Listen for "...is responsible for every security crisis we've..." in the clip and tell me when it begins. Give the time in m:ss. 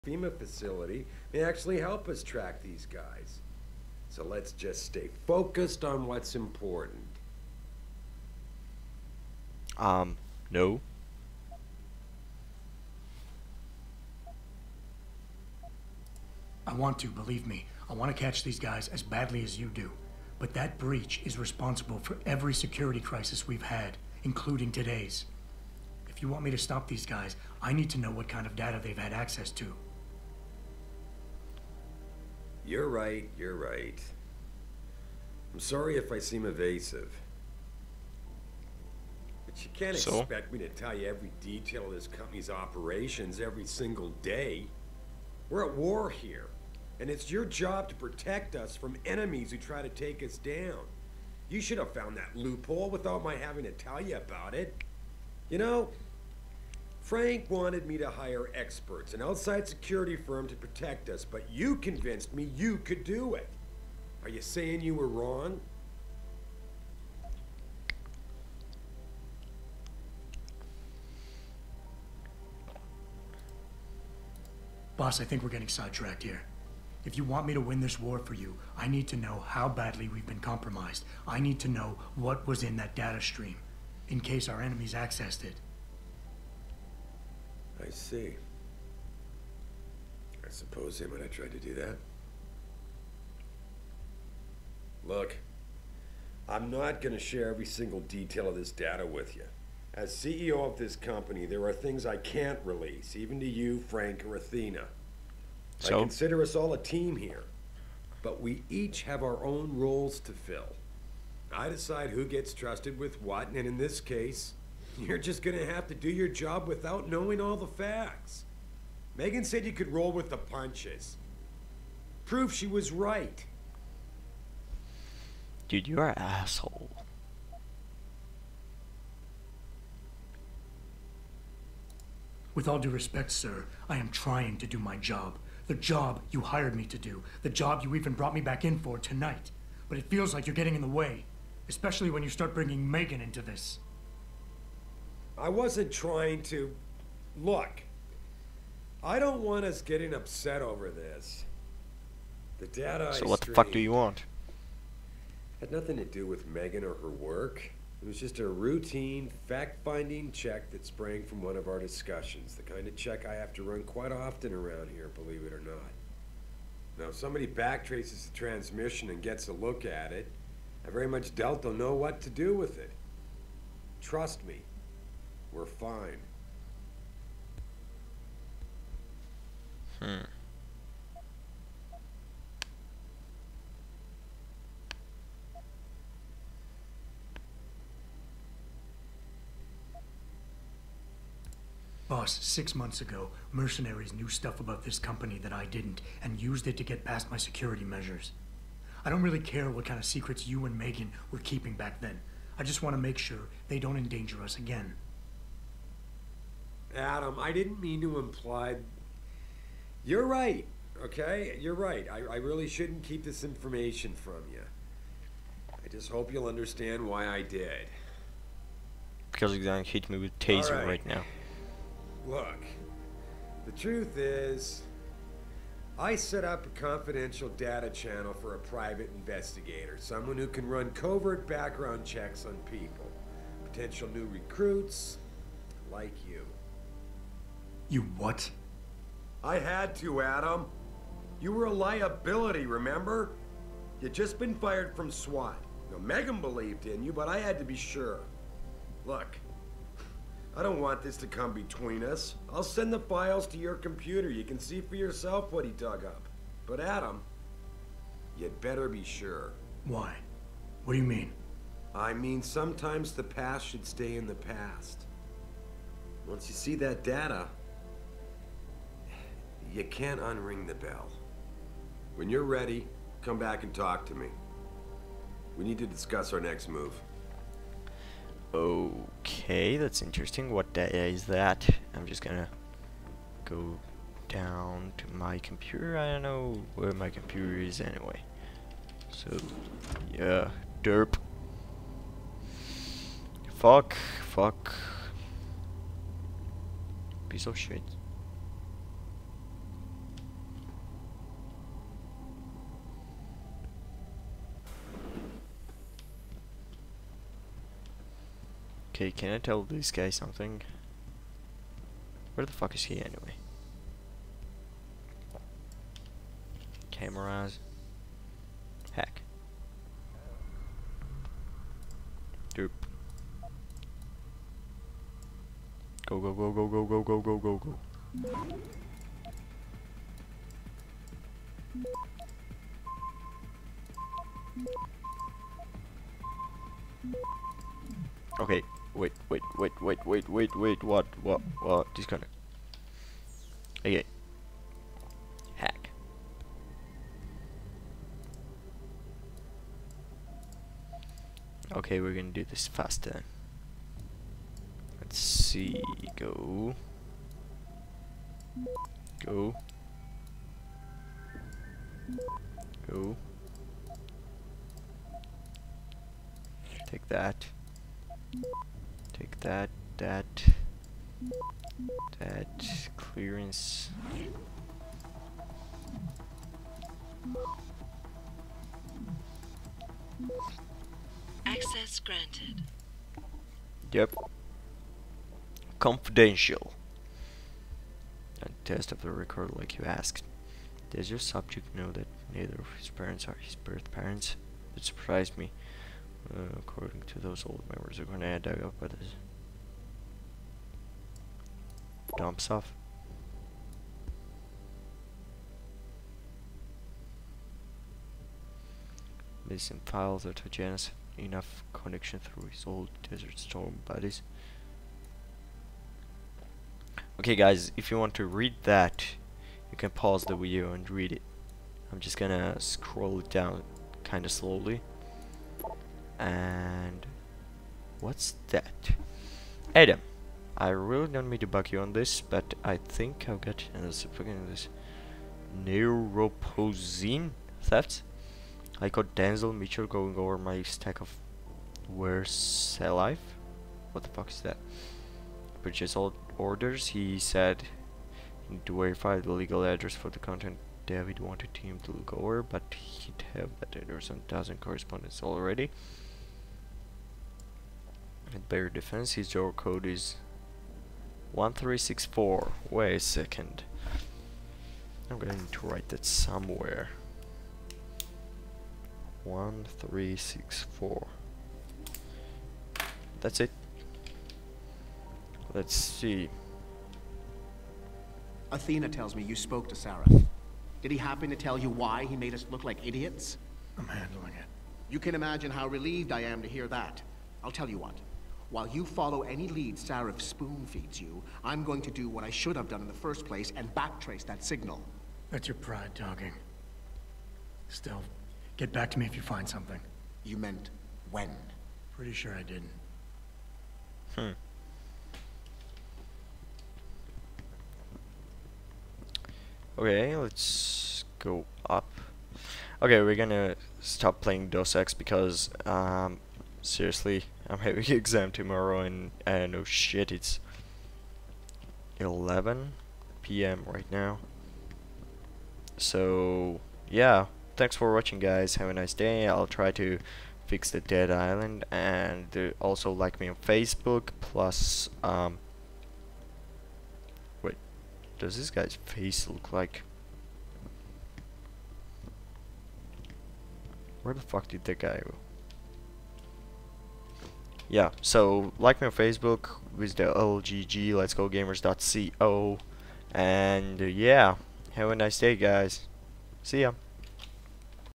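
0:21.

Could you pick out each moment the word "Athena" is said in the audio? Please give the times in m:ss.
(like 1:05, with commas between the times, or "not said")
1:44, 7:58.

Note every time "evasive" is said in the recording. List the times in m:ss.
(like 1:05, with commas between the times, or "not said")
0:36.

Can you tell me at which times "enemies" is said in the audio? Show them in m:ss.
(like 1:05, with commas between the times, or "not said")
0:49, 1:24.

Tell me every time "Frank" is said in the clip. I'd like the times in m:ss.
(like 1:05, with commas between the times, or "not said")
0:57, 1:43.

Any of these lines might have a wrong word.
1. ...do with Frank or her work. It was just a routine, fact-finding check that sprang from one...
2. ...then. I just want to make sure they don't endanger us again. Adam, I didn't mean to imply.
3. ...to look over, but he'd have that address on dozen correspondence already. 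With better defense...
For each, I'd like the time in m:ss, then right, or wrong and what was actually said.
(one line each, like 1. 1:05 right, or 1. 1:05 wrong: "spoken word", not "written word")
1. 2:36 wrong: "Megan", not "Frank"
2. 3:22 right
3. 7:31 right.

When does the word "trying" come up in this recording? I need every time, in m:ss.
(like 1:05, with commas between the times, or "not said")
2:14, 2:25.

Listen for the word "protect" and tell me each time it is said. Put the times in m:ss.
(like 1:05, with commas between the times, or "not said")
0:47, 1:00.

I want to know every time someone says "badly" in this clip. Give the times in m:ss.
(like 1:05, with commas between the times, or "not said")
0:19, 1:19.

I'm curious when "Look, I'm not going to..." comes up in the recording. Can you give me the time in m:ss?
1:35.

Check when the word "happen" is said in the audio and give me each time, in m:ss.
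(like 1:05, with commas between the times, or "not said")
8:00.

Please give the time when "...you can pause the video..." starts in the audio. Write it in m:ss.
6:59.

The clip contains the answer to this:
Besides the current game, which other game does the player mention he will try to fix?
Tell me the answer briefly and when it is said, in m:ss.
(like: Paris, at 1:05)
Dead Island, at 8:50.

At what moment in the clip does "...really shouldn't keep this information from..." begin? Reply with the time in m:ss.
3:32.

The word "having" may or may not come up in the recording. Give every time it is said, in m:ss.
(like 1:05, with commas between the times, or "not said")
0:53, 8:37.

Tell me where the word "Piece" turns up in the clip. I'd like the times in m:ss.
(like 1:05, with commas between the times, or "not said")
4:57.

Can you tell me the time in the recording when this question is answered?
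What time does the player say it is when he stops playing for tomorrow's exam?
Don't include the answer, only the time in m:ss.
8:41.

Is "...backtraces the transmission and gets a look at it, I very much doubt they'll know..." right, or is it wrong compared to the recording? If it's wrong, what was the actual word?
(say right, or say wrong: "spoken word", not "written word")
right.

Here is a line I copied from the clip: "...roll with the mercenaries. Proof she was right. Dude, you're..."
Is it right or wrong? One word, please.
wrong.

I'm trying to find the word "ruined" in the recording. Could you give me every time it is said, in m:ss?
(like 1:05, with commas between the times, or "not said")
not said.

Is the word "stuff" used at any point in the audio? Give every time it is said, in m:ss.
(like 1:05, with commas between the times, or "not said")
3:14, 6:42.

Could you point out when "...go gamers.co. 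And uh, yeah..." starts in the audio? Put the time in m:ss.
9:11.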